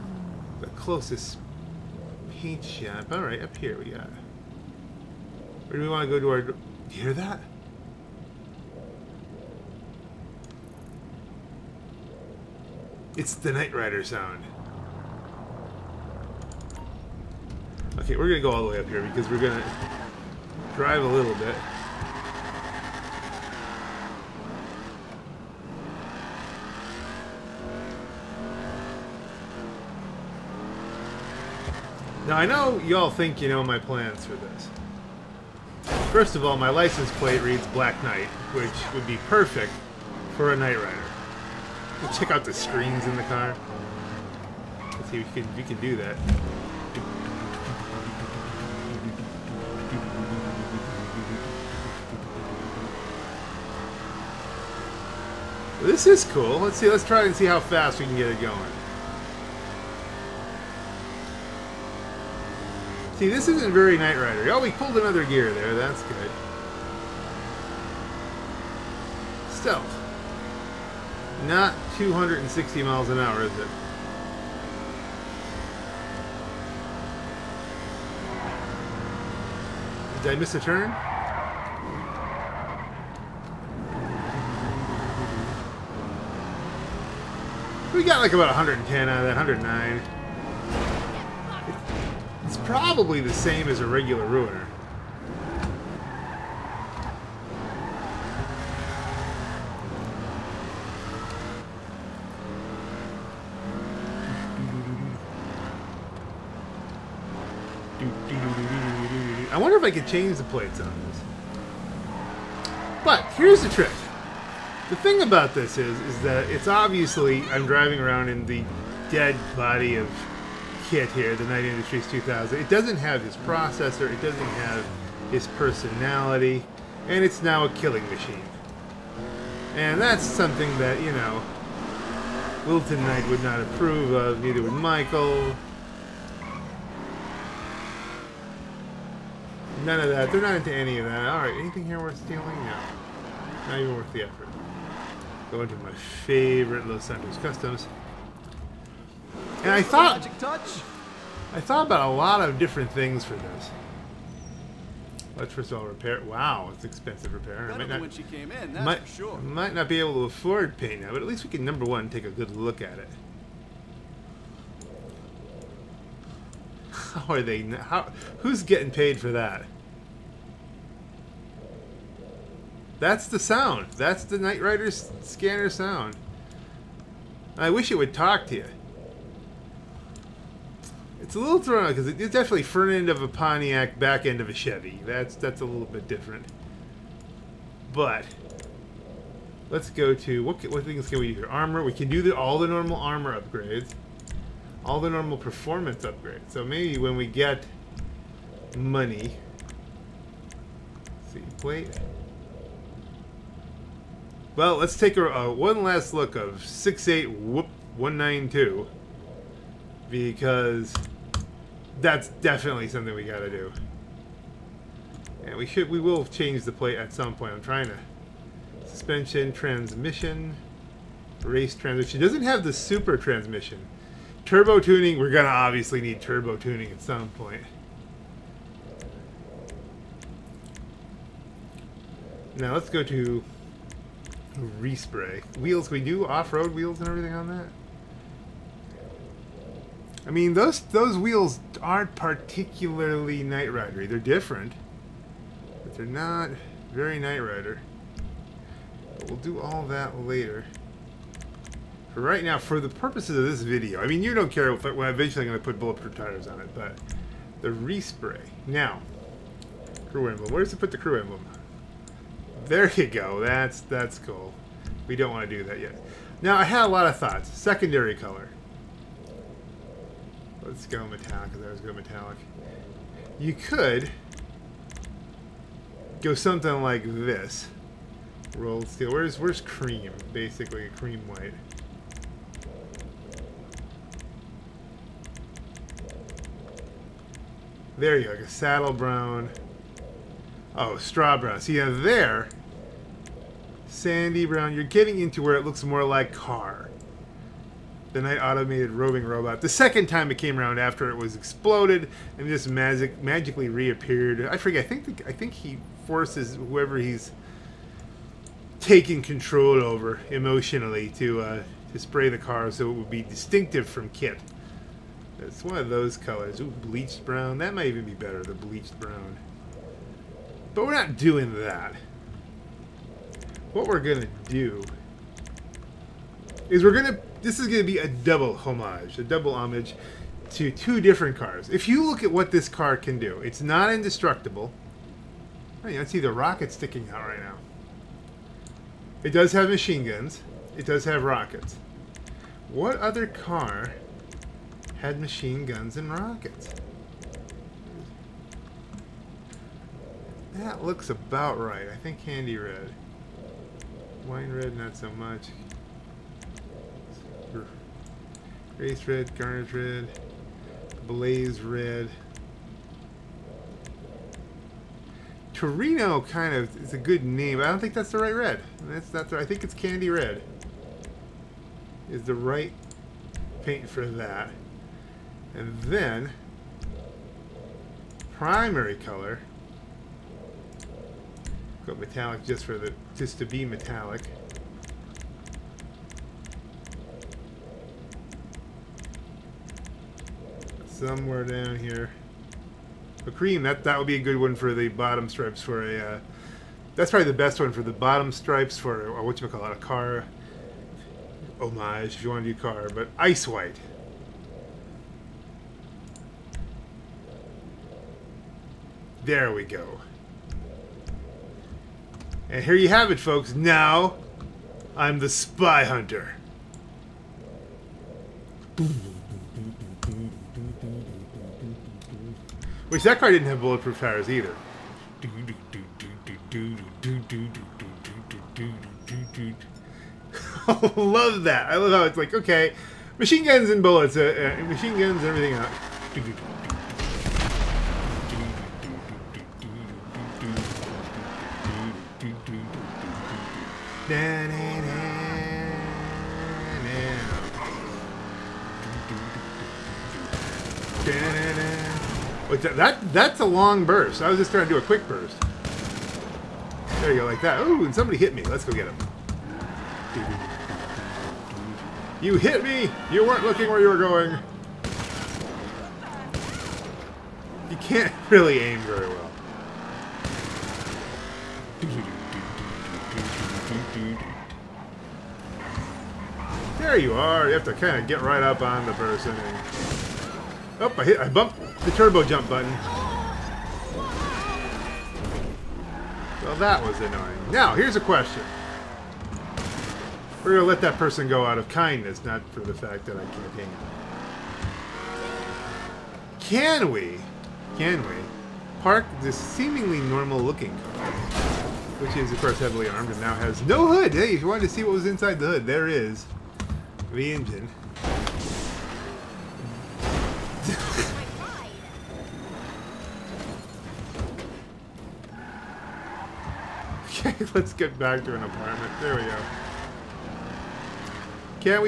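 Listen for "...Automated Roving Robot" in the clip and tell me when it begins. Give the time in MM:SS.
04:58.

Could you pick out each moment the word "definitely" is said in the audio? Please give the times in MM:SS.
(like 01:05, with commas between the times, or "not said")
03:02, 03:32.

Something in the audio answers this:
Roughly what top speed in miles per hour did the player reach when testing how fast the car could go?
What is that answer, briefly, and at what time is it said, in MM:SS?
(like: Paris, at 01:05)
110, at 01:28.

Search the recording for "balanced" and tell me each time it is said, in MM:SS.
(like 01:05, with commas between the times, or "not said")
not said.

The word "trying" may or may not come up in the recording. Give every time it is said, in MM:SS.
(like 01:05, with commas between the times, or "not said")
03:37, 07:34.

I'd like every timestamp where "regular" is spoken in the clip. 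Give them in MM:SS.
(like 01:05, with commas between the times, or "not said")
01:33.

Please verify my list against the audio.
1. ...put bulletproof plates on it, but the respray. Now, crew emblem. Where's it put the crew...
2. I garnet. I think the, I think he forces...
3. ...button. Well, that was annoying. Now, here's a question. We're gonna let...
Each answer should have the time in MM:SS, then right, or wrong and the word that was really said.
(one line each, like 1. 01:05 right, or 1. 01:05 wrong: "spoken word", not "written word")
1. 04:15 wrong: "tires", not "plates"
2. 05:04 wrong: "forget", not "garnet"
3. 08:02 right.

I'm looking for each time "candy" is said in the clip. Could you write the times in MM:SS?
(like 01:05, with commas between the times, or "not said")
05:52, 06:09.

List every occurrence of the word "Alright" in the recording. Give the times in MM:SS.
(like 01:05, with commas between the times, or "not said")
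00:03, 02:21.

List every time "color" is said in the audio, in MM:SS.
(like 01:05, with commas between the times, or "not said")
04:28, 05:16, 06:18.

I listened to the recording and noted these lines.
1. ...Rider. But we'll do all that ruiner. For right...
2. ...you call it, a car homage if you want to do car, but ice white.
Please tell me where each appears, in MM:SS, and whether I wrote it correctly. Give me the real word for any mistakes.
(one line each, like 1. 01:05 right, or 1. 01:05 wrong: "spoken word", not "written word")
1. 04:07 wrong: "later", not "ruiner"
2. 06:39 right.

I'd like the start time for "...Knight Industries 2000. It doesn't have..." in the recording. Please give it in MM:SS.
02:01.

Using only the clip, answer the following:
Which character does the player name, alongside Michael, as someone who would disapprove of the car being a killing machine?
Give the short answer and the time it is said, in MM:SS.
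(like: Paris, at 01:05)
Wilton Knight, at 02:12.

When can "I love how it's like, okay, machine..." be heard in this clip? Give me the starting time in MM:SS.
07:11.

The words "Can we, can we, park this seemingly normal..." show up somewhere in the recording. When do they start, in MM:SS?
08:16.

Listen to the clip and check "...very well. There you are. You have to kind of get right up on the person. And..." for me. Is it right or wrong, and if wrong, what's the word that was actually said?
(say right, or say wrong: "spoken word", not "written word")
right.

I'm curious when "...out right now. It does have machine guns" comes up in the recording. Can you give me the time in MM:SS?
05:37.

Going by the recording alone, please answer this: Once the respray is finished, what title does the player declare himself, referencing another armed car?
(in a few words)
Spy Hunter.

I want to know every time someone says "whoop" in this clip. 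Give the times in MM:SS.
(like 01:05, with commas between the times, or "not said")
03:27.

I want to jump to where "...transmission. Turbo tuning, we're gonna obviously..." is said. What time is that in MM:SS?
03:43.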